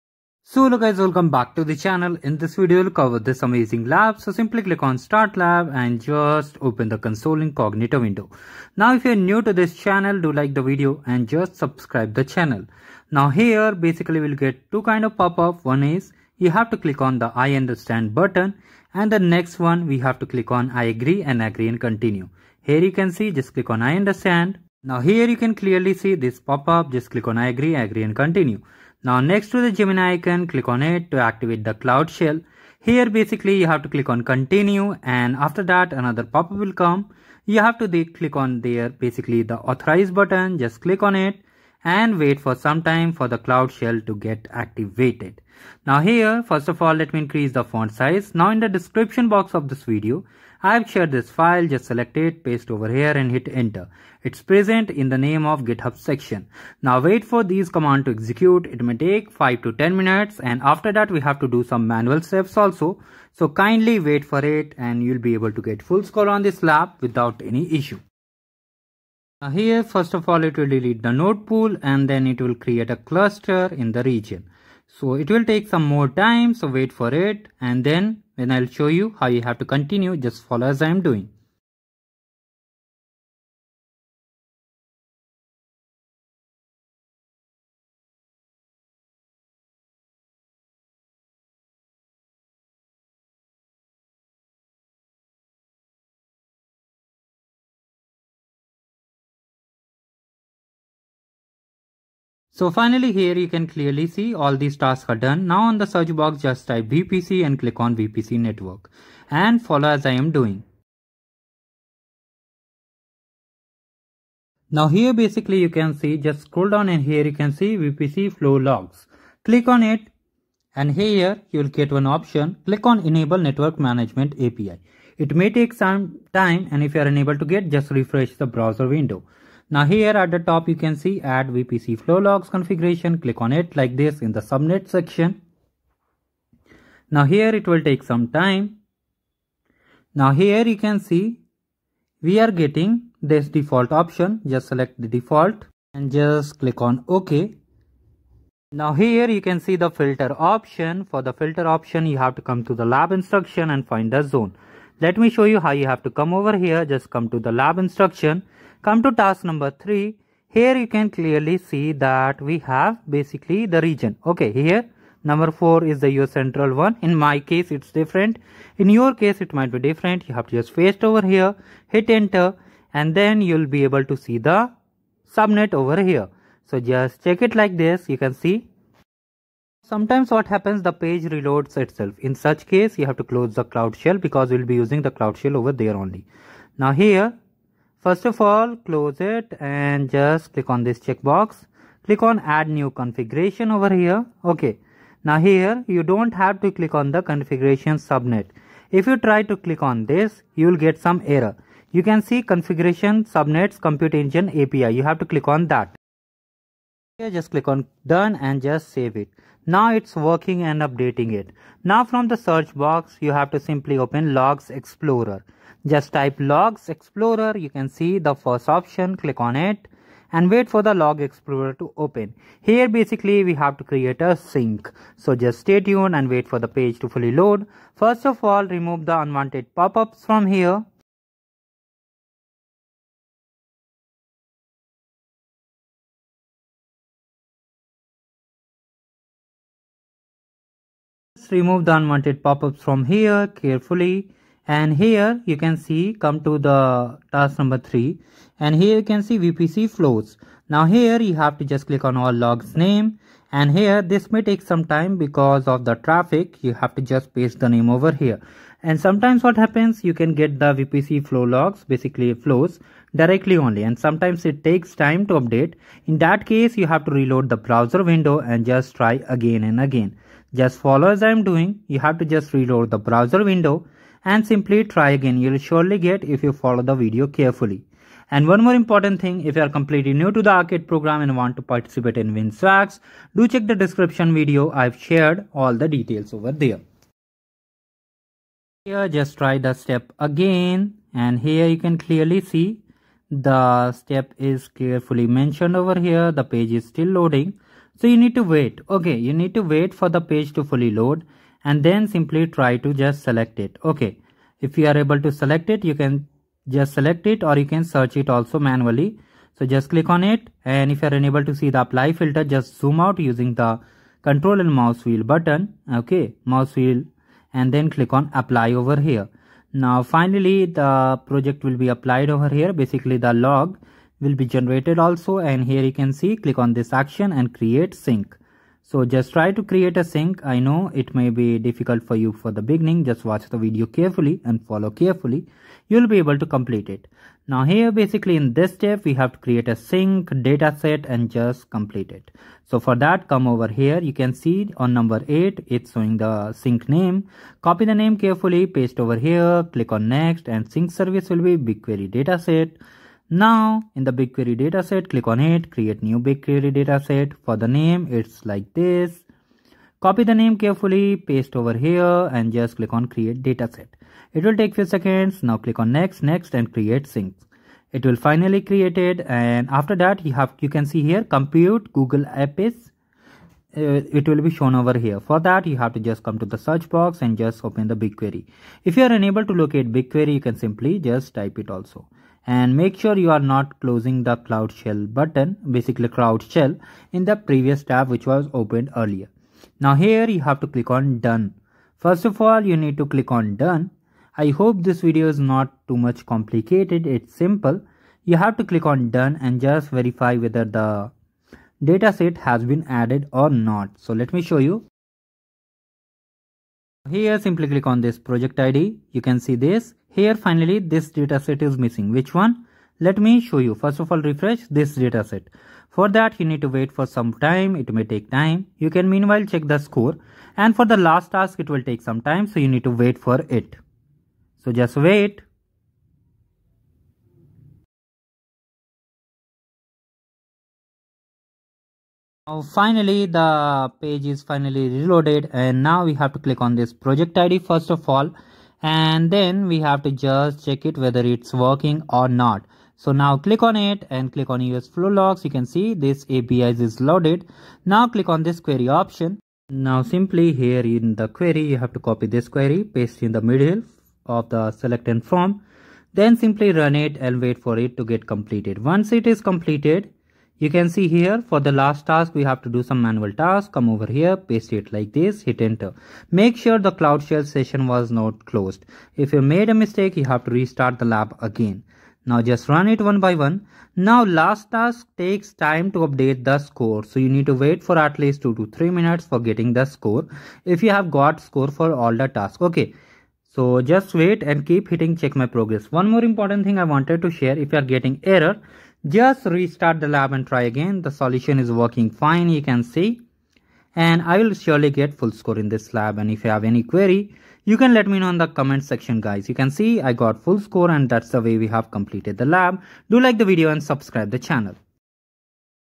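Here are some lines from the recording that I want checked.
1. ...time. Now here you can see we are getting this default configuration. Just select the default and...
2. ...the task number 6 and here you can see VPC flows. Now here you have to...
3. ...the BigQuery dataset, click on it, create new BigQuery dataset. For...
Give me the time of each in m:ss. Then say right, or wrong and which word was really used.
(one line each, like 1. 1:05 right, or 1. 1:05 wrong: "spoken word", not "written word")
1. 2:18 wrong: "option", not "configuration"
2. 4:06 wrong: "3", not "6"
3. 5:54 right.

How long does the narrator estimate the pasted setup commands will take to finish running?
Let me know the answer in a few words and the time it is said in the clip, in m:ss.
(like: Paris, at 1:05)
5 to 10 minutes, at 0:59.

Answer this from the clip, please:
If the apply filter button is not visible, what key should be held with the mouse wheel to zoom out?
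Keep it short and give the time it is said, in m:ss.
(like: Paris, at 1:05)
Control, at 5:14.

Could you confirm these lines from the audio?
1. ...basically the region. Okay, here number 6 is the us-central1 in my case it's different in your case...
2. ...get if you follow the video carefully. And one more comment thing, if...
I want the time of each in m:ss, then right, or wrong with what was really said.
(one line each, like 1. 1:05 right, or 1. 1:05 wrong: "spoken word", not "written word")
1. 2:43 wrong: "4", not "6"
2. 4:35 wrong: "important", not "comment".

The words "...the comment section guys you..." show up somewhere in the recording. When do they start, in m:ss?
8:18.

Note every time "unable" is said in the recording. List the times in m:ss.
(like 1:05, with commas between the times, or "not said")
2:07, 5:11, 6:19.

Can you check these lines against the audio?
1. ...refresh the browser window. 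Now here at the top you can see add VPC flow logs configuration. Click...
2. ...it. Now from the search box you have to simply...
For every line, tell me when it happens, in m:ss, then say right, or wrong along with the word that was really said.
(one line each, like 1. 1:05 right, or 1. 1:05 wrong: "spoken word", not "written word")
1. 2:07 right
2. 3:31 right.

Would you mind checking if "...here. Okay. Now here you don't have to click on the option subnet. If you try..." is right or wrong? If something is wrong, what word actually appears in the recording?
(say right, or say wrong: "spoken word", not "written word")
wrong: "configuration", not "option".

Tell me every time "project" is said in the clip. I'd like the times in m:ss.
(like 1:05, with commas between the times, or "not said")
5:21, 6:48, 7:16.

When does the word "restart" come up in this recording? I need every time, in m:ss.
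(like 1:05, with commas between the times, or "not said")
7:50, 8:09.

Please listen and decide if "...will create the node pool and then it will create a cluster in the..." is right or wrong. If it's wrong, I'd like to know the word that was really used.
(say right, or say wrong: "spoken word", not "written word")
wrong: "delete", not "create".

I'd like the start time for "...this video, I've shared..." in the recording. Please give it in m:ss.
0:49.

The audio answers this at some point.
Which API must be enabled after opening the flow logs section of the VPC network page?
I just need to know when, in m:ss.
2:03.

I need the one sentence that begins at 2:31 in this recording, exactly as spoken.
For the filter option you have to come to the lab instruction and find the zone.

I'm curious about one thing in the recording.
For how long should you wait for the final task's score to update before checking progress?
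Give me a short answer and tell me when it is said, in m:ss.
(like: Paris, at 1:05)
2 to 3 minutes, at 7:58.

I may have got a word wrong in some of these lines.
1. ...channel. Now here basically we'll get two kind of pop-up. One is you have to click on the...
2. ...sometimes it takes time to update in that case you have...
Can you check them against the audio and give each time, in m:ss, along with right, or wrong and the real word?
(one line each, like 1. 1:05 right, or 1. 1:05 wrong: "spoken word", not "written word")
1. 0:12 right
2. 4:23 right.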